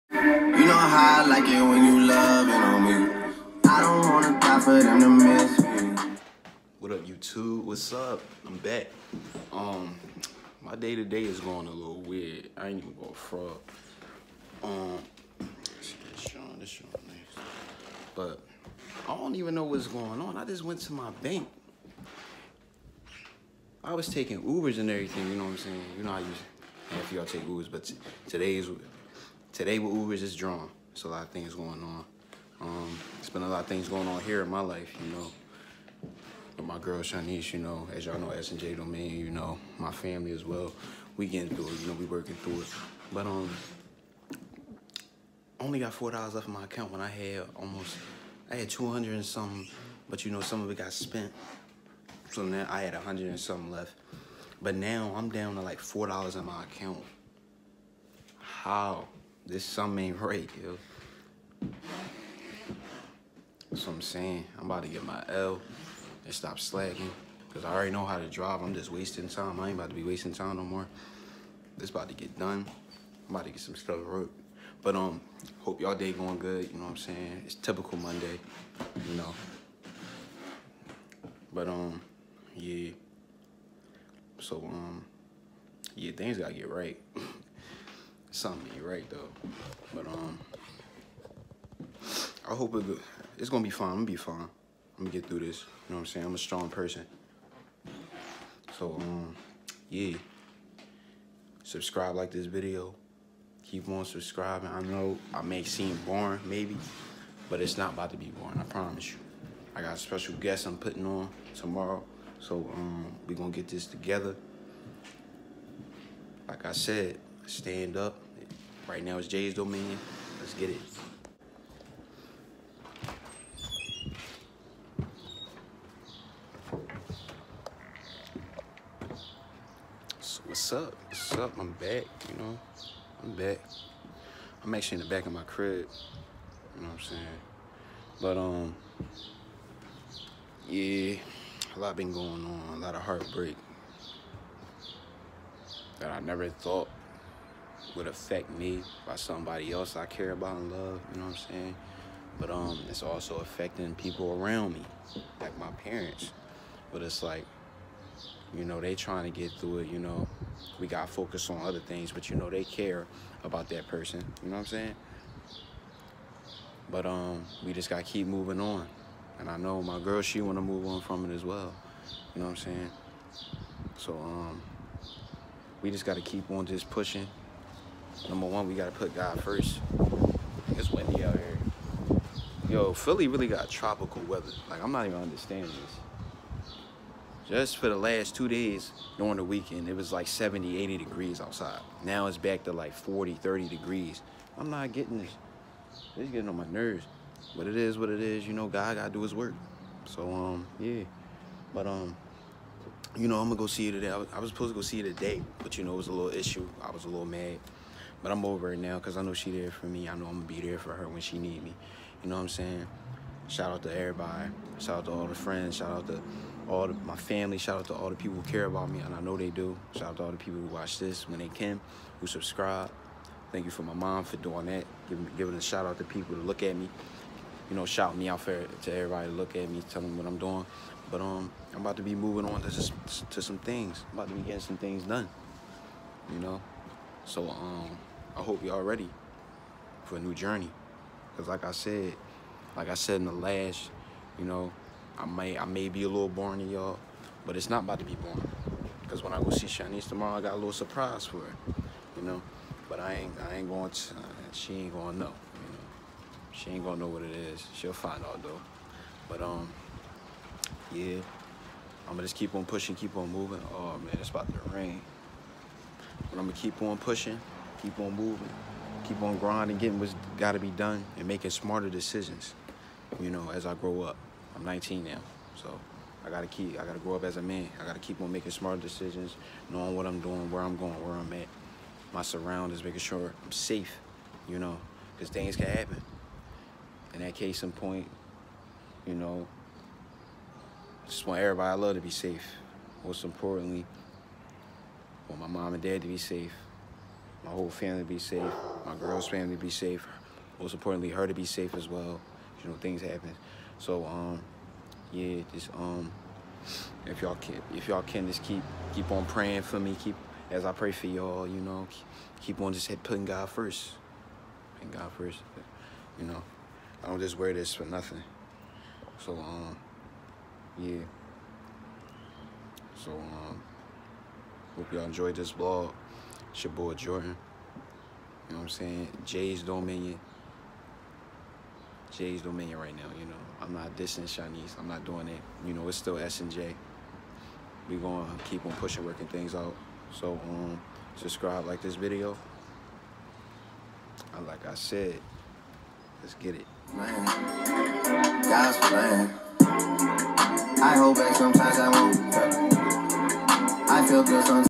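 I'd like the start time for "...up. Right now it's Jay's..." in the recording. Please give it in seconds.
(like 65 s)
117 s.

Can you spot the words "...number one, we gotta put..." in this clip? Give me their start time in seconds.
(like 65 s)
178 s.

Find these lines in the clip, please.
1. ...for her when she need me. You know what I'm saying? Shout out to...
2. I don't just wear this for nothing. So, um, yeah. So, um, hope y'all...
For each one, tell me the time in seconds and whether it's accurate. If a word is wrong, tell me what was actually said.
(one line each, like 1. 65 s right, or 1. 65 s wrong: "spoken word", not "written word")
1. 210 s right
2. 317 s right.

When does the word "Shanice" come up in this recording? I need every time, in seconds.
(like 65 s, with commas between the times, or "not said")
36 s, 249 s, 334 s.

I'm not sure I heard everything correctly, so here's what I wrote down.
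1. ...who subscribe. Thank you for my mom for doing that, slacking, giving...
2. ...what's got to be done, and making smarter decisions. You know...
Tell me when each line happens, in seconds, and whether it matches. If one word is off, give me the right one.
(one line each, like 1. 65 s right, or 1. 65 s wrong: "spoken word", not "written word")
1. 222 s wrong: "giving", not "slacking"
2. 269 s right.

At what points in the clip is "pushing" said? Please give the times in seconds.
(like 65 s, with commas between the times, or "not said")
176 s, 262 s, 266 s, 338 s.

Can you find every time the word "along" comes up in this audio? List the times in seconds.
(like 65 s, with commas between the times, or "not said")
not said.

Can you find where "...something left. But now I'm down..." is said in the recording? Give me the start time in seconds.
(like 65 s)
53 s.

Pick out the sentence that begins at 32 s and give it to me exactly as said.
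Um, it's been a lot of things going on here in my life, you know.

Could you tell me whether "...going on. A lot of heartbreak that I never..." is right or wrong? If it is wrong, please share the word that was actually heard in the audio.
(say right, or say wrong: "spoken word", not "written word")
right.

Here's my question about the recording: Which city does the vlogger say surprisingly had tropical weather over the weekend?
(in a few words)
Philly.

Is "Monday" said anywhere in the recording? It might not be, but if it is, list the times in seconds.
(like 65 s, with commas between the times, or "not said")
77 s.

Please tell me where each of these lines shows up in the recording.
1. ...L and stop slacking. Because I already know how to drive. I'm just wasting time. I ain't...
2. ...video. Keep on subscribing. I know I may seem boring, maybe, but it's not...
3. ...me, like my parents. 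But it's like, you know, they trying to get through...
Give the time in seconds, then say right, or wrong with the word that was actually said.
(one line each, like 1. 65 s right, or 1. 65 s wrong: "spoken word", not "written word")
1. 65 s right
2. 102 s right
3. 154 s right.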